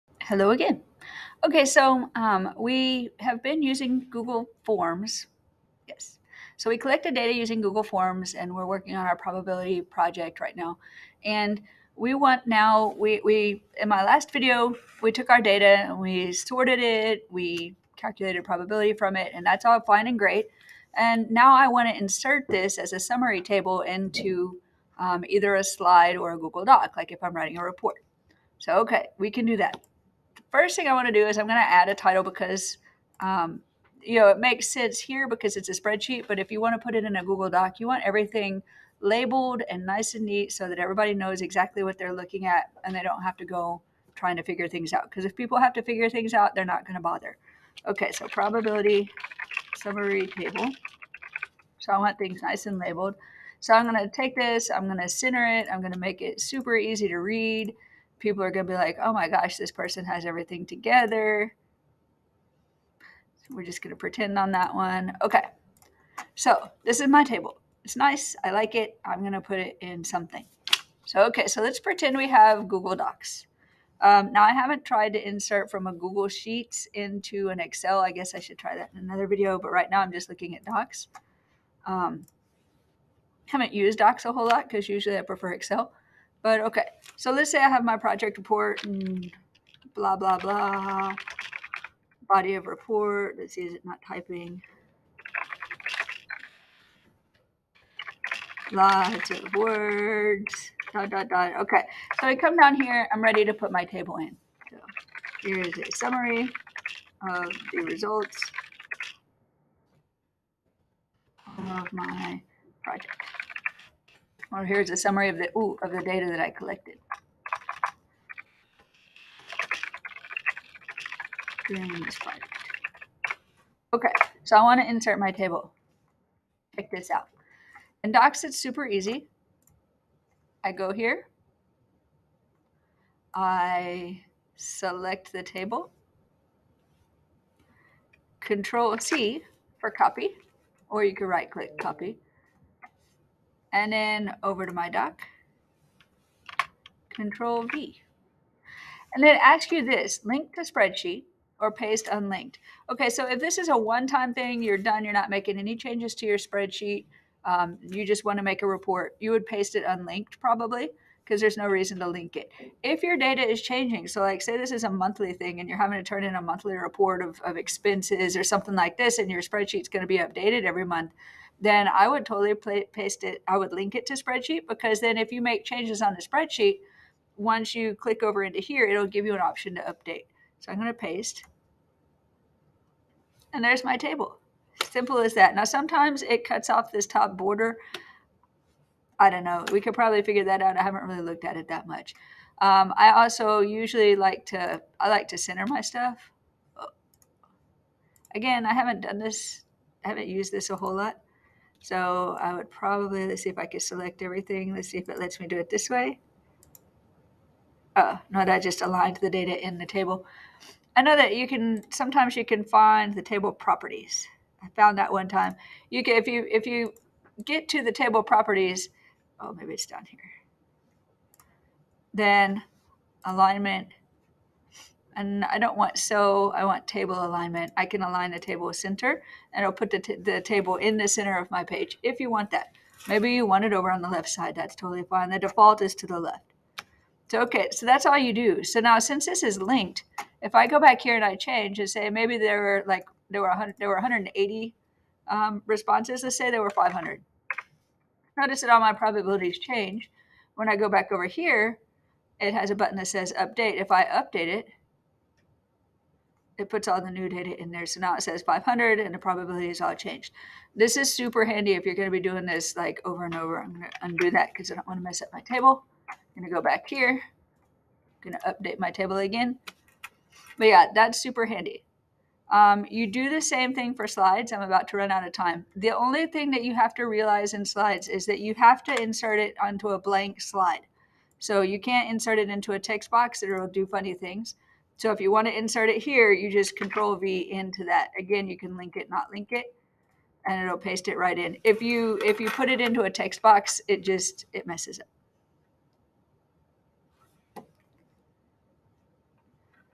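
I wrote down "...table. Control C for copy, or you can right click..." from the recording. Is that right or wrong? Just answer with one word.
right.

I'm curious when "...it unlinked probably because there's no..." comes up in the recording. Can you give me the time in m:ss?
2:39.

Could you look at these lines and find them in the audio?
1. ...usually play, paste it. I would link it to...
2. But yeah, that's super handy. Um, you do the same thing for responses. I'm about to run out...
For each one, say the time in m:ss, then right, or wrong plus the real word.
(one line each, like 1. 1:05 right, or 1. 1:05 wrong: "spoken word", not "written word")
1. 2:52 wrong: "totally", not "usually"
2. 4:30 wrong: "slides", not "responses".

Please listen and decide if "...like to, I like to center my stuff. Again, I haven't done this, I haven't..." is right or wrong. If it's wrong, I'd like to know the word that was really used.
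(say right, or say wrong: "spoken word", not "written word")
right.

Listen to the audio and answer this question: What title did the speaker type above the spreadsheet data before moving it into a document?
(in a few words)
Probability summary table.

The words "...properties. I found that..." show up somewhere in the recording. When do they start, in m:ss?
3:33.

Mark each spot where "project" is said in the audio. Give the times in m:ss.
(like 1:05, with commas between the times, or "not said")
0:09, 1:27, 1:52.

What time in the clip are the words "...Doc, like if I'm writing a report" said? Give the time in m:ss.
0:26.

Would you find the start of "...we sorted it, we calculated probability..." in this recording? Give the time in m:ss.
0:15.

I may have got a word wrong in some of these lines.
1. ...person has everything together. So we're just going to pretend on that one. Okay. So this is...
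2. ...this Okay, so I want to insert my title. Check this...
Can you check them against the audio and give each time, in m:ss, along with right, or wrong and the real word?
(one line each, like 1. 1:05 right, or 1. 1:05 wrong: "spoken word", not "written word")
1. 0:59 right
2. 2:02 wrong: "table", not "title".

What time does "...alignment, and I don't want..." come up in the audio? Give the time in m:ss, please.
3:43.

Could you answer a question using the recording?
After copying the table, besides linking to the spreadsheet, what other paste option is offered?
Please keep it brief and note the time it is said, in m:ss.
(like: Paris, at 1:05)
Paste unlinked, at 2:31.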